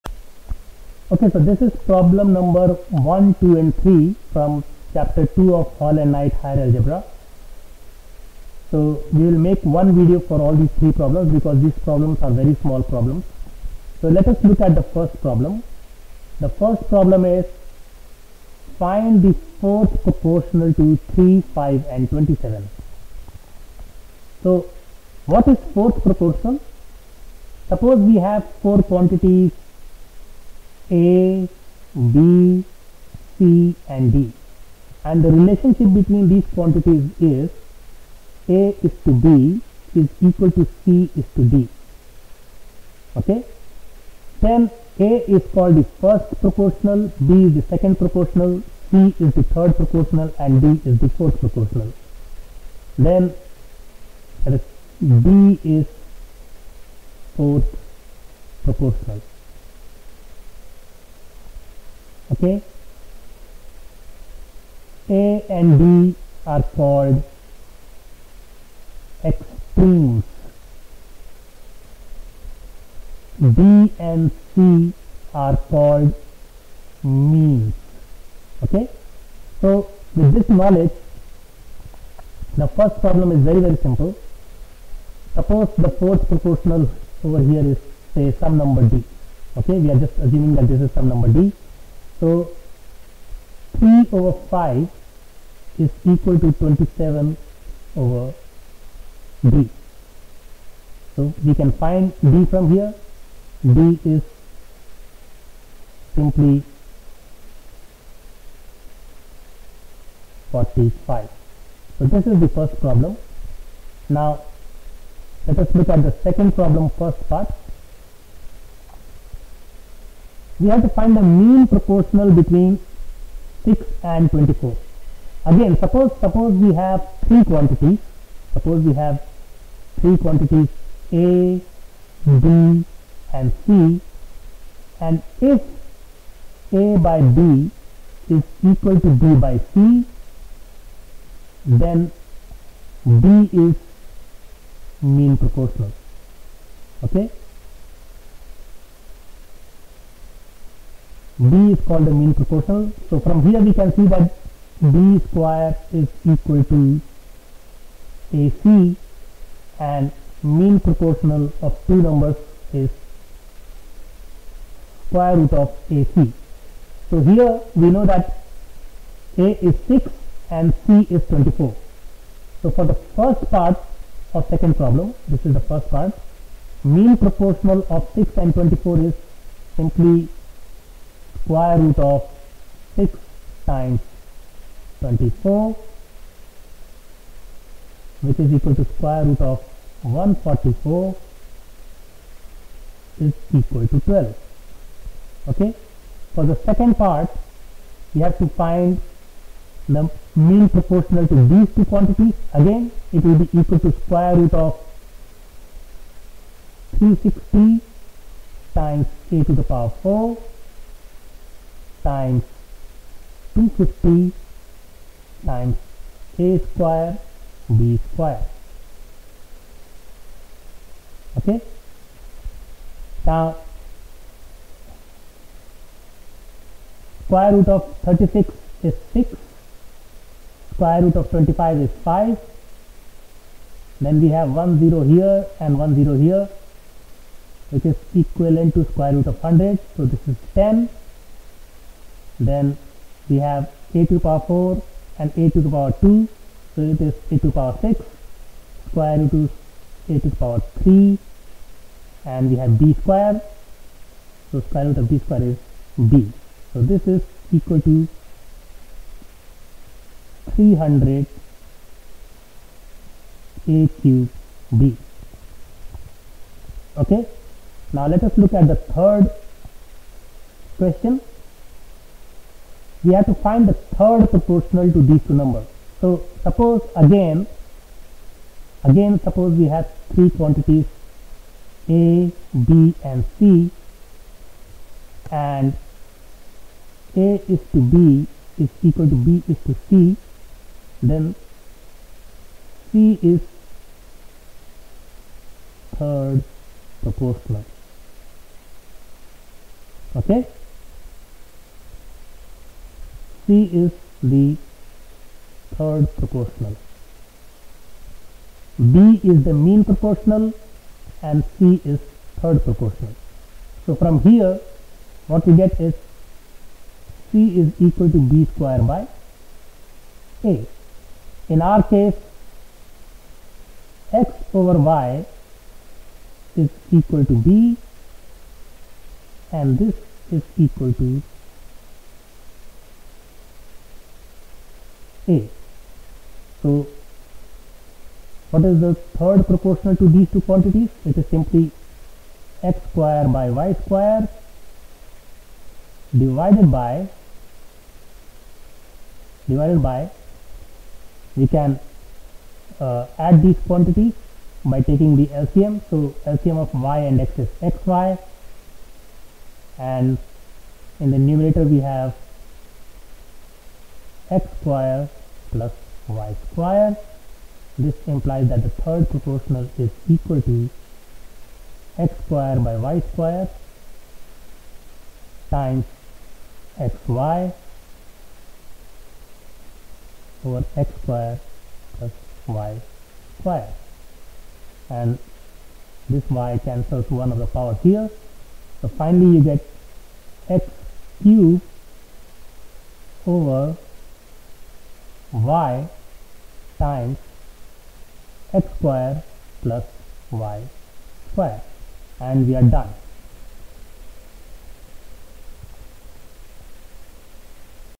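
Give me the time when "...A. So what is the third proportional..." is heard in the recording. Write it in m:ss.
5:35.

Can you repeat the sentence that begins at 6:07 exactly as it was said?
This implies that the third proportional is equal to x squared by y squared times xy over x squared plus y squared.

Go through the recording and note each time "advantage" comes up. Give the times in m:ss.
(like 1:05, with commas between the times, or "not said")
not said.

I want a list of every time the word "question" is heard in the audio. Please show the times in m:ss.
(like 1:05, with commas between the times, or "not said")
4:30.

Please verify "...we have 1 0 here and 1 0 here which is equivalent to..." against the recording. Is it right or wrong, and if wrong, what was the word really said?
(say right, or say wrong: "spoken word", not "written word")
right.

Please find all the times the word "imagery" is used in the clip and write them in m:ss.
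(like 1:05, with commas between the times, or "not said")
not said.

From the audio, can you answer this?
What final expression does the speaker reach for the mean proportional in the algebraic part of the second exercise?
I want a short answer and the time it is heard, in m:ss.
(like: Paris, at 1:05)
300a³b, at 4:20.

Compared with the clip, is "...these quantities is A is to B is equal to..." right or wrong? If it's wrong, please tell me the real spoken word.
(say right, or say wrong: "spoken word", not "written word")
right.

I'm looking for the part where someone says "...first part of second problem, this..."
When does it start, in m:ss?
2:52.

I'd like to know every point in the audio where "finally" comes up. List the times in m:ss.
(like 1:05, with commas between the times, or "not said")
6:28.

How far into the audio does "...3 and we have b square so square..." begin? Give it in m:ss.
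4:10.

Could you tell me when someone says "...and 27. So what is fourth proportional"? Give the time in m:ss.
0:21.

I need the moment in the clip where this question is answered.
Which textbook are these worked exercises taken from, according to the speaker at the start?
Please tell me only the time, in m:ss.
0:05.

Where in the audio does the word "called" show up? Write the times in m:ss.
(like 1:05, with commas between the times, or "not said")
0:45, 1:06, 1:15, 2:31.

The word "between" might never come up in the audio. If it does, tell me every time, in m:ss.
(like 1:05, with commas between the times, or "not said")
0:35, 2:02.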